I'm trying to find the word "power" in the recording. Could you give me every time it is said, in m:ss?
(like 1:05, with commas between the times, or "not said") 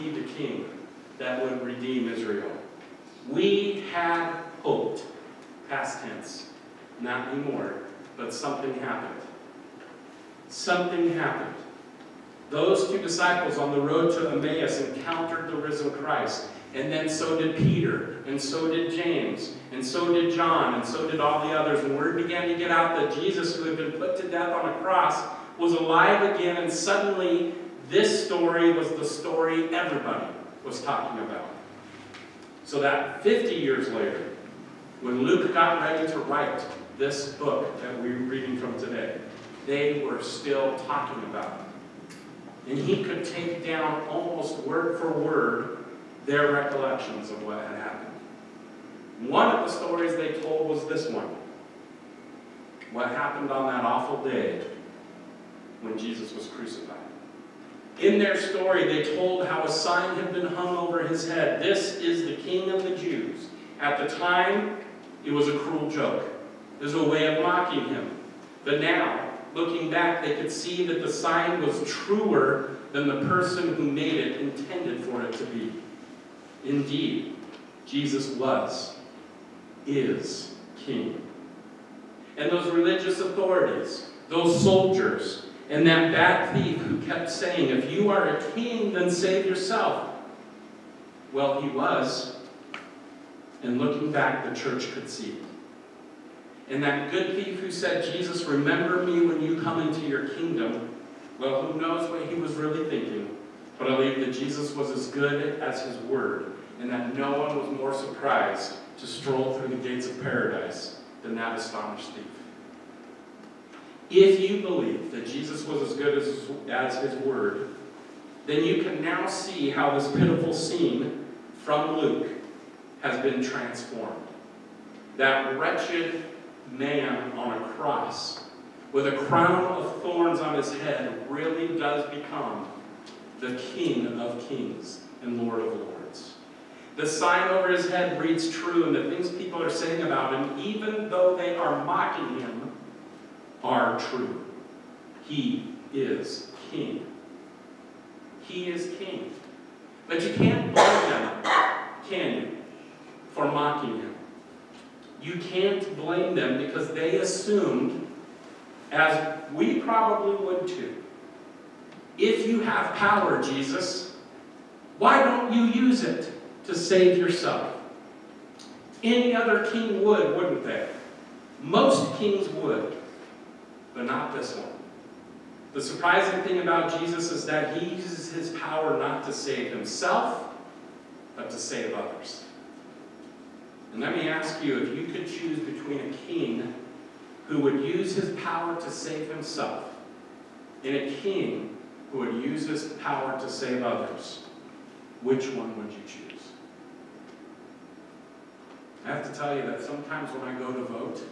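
2:42, 2:58, 3:08, 3:13.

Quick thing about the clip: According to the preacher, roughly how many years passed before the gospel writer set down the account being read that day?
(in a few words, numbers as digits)
50.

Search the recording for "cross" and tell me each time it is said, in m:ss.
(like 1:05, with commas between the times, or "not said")
0:24, 2:07.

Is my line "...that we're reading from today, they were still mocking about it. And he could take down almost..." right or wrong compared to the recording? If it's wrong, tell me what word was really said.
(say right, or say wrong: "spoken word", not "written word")
wrong: "talking", not "mocking".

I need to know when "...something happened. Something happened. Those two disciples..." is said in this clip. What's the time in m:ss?
0:08.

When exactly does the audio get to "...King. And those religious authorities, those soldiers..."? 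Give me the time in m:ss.
1:20.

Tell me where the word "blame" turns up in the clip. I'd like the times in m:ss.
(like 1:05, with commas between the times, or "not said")
2:30, 2:35.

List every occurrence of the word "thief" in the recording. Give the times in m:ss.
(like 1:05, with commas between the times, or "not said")
1:26, 1:37, 1:52.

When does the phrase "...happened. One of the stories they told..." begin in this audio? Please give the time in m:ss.
0:47.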